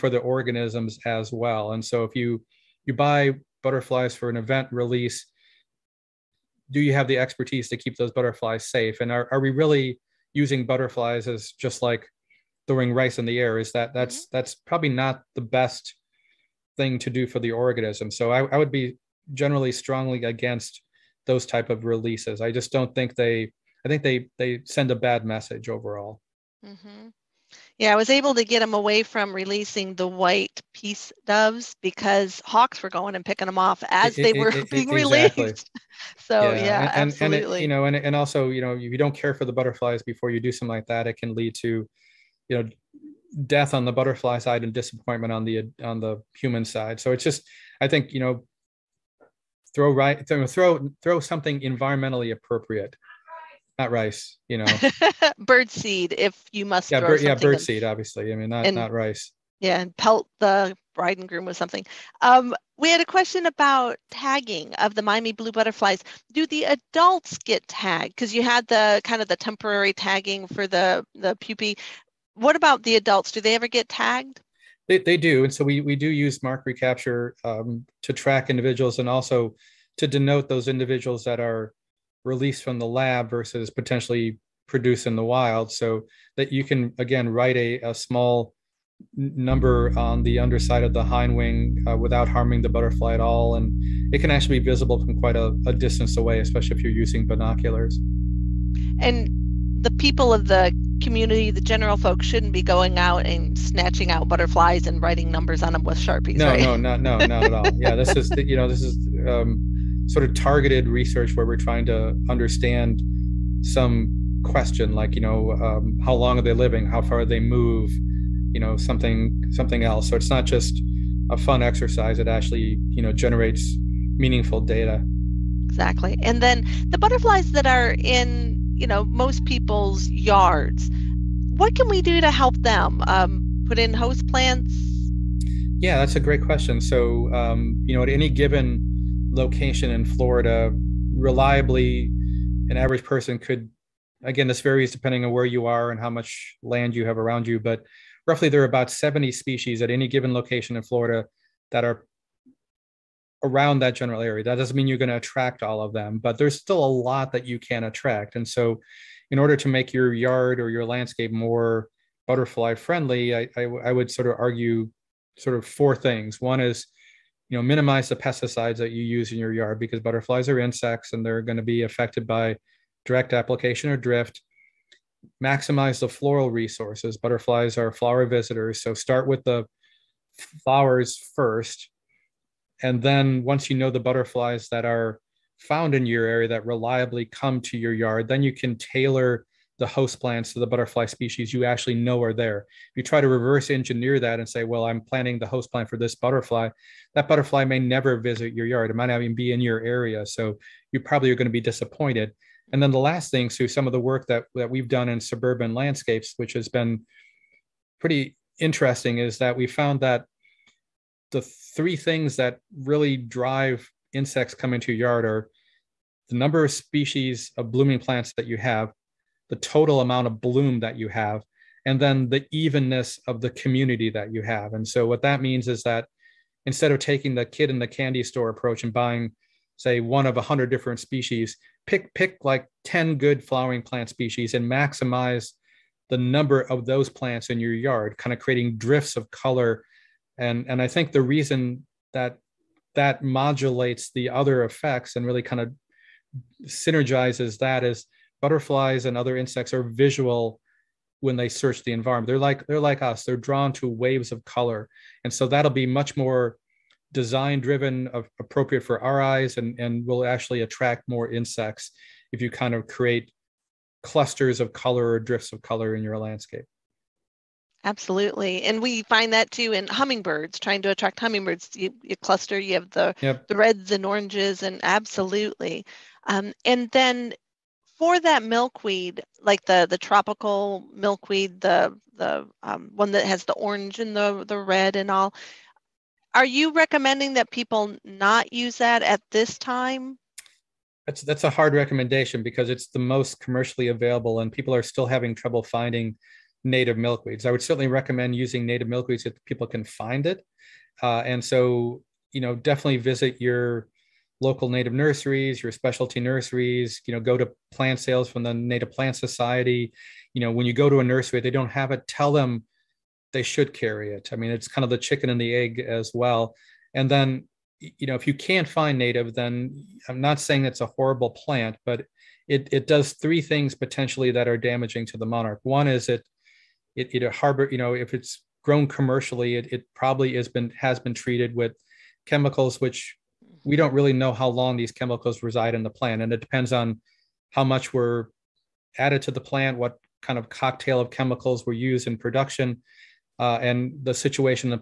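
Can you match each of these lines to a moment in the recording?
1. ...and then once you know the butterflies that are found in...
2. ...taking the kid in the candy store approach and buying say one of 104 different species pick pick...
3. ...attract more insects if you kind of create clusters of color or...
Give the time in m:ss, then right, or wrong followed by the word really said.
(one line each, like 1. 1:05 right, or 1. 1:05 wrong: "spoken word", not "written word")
1. 3:02 right
2. 3:46 wrong: "100", not "104"
3. 4:20 right.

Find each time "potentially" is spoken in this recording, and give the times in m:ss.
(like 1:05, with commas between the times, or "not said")
1:23, 5:23.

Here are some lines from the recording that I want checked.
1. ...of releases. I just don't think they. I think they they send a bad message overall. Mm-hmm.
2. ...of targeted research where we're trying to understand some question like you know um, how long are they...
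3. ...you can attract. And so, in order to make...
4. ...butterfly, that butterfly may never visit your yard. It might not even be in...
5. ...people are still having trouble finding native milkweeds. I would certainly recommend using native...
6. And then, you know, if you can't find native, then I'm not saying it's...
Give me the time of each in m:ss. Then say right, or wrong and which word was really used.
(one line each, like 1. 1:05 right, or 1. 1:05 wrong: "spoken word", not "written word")
1. 0:21 right
2. 1:50 right
3. 2:37 right
4. 3:16 right
5. 4:54 right
6. 5:16 right.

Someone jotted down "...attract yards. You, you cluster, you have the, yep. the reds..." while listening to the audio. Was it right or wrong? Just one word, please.
wrong.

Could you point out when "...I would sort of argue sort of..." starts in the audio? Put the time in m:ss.
2:43.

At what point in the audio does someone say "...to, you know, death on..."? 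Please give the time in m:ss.
0:41.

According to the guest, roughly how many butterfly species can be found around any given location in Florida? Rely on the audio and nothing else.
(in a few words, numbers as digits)
70.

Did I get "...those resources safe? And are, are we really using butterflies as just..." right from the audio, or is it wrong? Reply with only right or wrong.
wrong.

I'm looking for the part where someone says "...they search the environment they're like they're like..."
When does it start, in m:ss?
4:11.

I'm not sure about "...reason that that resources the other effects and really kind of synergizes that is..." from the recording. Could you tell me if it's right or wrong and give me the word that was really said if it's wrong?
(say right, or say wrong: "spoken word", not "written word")
wrong: "modulates", not "resources".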